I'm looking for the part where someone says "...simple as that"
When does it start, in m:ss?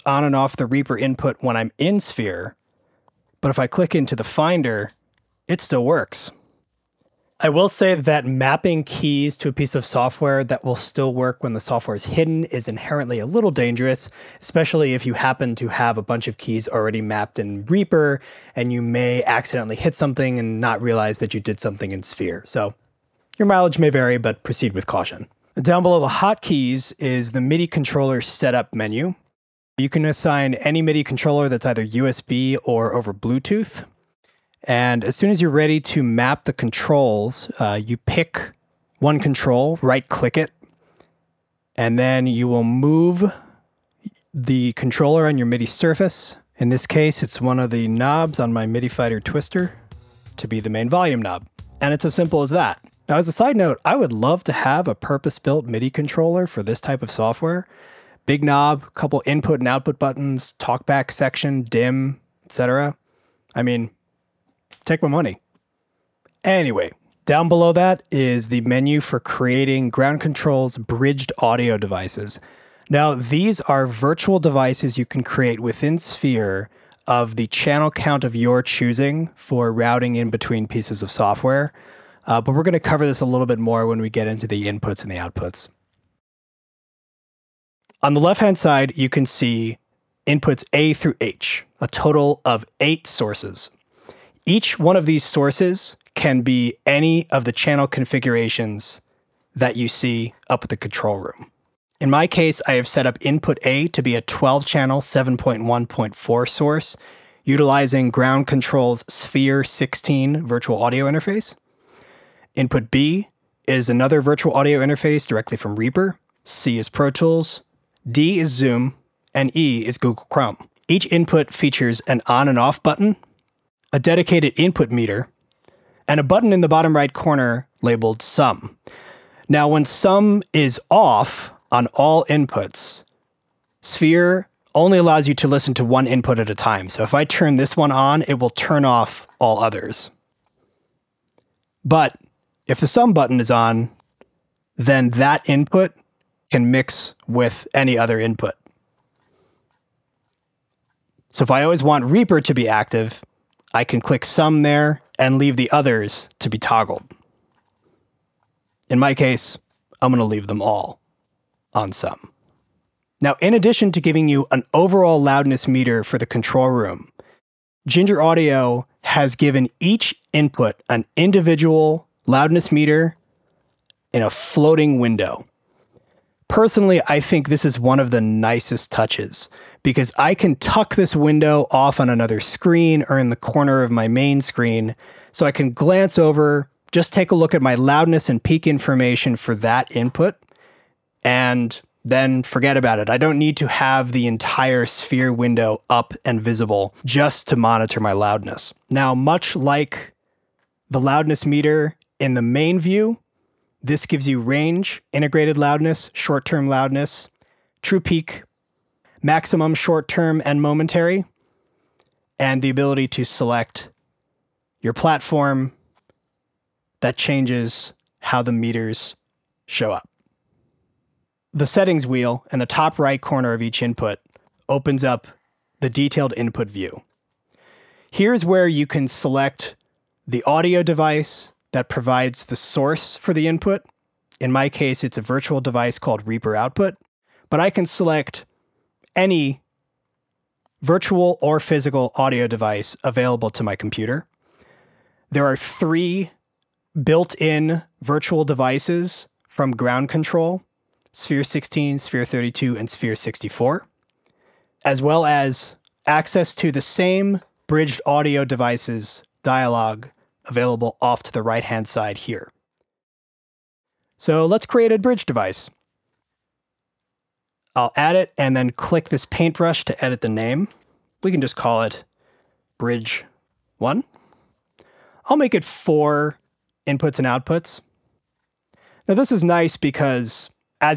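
0:52.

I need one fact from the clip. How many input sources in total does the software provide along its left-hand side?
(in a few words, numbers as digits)
8.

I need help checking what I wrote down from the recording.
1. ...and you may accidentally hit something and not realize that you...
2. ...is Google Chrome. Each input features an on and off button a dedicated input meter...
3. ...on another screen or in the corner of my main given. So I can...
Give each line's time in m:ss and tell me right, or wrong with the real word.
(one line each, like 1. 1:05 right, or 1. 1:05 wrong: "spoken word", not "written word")
1. 0:18 right
2. 1:59 right
3. 3:01 wrong: "screen", not "given".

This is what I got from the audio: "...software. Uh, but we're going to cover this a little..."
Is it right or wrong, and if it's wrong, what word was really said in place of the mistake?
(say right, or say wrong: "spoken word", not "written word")
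right.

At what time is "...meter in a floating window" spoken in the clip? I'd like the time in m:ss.
2:52.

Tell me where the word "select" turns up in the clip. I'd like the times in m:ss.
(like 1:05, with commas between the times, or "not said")
3:33, 3:49, 3:57.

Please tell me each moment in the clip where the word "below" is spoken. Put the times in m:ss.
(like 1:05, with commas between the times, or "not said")
0:25, 1:07.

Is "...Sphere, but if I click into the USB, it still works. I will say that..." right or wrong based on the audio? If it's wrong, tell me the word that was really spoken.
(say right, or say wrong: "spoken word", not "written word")
wrong: "Finder", not "USB".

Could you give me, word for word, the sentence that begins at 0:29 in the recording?
You can assign any MIDI controller that's either USB or over Bluetooth.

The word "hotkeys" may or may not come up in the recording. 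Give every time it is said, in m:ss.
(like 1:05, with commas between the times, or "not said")
0:26.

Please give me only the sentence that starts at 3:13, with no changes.
I don't need to have the entire sphere window up and visible just to monitor my loudness.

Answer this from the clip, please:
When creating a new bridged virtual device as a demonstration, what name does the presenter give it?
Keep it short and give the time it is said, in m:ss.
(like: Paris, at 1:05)
bridge one, at 4:32.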